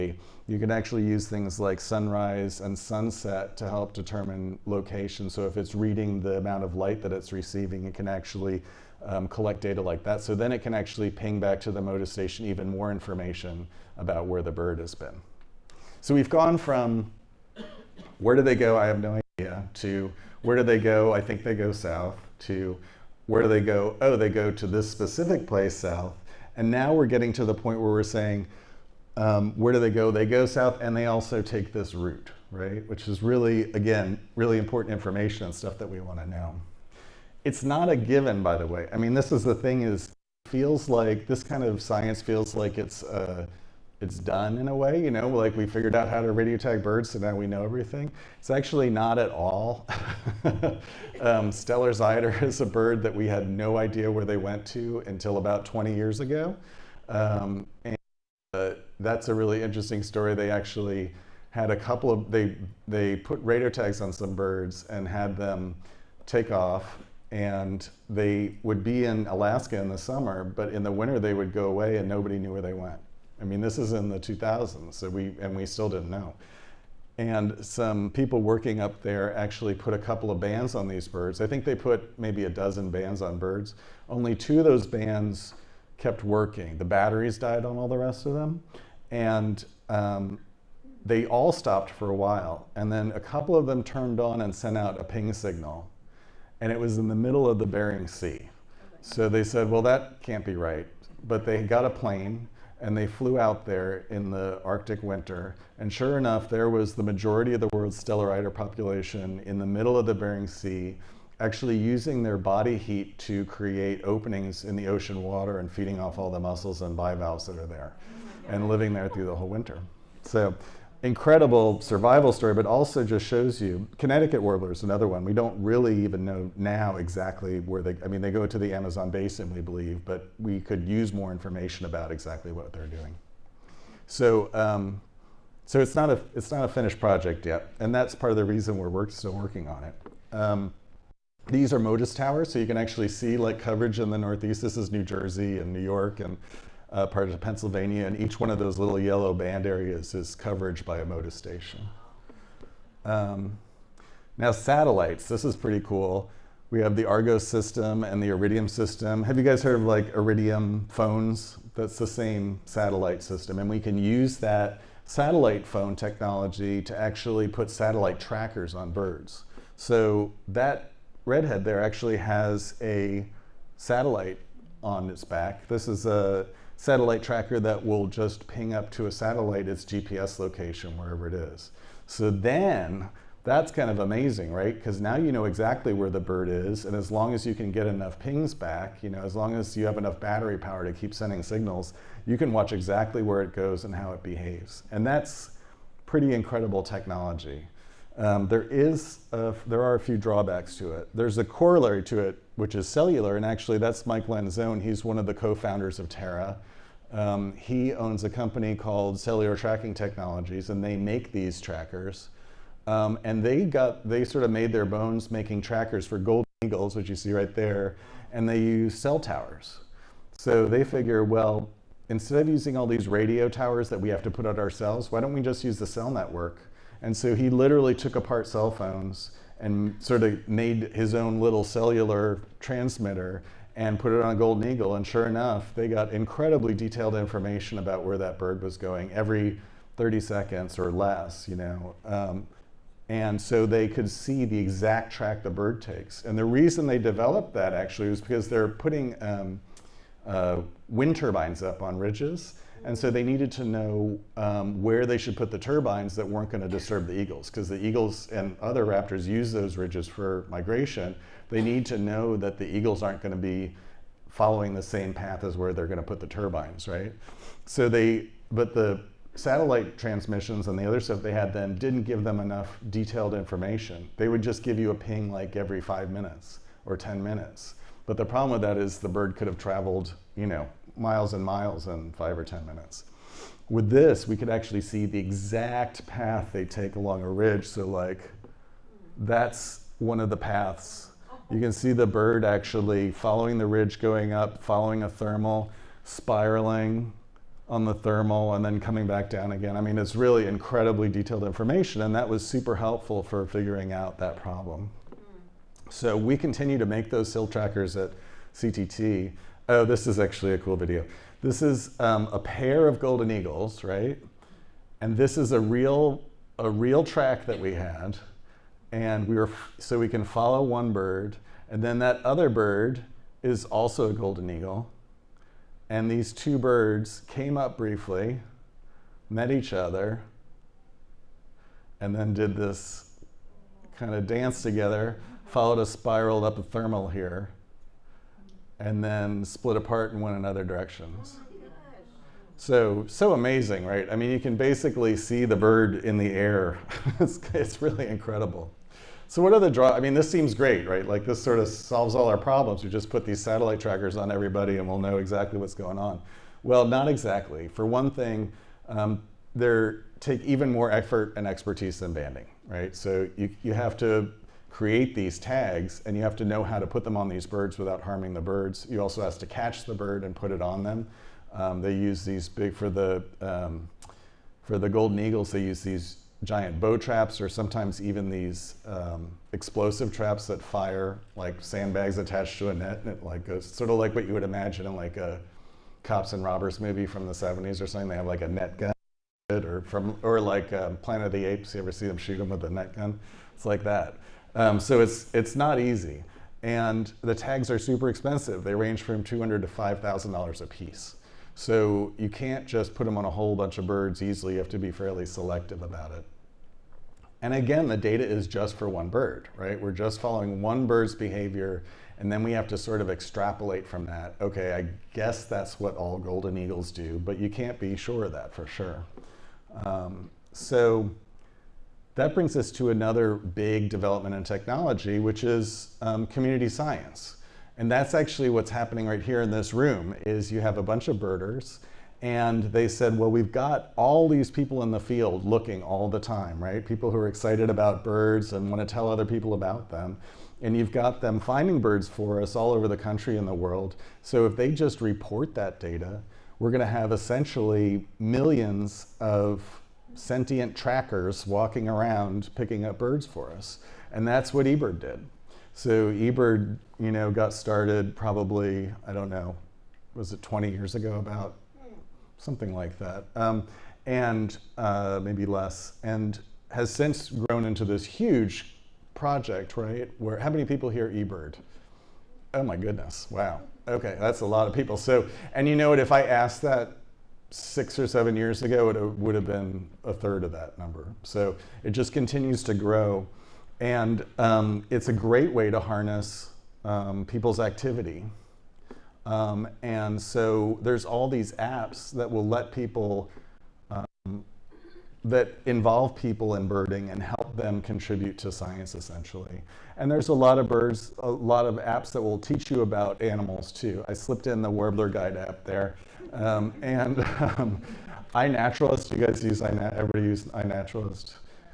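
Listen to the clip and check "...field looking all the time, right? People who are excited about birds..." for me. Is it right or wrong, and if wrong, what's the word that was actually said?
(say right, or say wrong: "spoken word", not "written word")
right.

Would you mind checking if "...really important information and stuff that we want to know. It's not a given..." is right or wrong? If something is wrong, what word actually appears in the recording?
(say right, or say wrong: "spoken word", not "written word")
right.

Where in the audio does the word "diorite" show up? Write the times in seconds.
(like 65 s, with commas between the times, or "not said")
not said.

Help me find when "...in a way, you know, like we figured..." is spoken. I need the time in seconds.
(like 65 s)
44 s.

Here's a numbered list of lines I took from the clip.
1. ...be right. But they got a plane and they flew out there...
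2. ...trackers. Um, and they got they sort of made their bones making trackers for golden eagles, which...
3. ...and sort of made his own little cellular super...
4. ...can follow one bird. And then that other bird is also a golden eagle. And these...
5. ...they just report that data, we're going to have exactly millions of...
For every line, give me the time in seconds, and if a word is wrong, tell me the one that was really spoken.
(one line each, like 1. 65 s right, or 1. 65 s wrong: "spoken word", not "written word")
1. 100 s right
2. 211 s right
3. 229 s wrong: "transmitter", not "super"
4. 320 s right
5. 444 s wrong: "essentially", not "exactly".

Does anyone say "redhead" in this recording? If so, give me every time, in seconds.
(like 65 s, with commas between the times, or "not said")
171 s.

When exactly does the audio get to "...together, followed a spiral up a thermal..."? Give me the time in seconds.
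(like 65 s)
334 s.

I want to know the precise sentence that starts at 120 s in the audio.
So incredible survival story, but also just shows you Connecticut warblers, another one.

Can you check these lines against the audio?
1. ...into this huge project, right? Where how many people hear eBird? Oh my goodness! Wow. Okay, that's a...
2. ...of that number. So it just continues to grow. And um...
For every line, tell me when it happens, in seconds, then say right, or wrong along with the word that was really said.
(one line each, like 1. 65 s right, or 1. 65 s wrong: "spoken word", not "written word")
1. 467 s right
2. 480 s right.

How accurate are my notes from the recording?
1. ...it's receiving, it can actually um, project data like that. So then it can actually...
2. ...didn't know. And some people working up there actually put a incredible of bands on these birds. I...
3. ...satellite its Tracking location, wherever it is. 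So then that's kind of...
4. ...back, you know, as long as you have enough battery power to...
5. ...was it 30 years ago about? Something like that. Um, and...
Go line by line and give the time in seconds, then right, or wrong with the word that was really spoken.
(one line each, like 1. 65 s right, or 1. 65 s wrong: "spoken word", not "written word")
1. 7 s wrong: "collect", not "project"
2. 75 s wrong: "couple", not "incredible"
3. 179 s wrong: "GPS", not "Tracking"
4. 188 s right
5. 460 s wrong: "20", not "30".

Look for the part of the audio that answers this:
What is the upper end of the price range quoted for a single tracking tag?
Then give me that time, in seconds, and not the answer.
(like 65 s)
399 s.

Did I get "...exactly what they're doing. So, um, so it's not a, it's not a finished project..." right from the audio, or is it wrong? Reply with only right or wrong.
right.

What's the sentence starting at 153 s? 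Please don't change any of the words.
Um, now satellites, this is pretty cool.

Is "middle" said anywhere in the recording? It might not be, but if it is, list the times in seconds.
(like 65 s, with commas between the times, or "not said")
97 s, 109 s.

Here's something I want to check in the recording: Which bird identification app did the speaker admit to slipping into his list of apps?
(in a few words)
Warbler Guide.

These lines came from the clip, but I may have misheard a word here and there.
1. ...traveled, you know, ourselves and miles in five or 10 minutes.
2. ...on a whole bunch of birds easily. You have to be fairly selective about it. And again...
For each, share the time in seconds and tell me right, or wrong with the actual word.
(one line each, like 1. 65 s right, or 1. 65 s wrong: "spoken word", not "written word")
1. 279 s wrong: "miles", not "ourselves"
2. 403 s right.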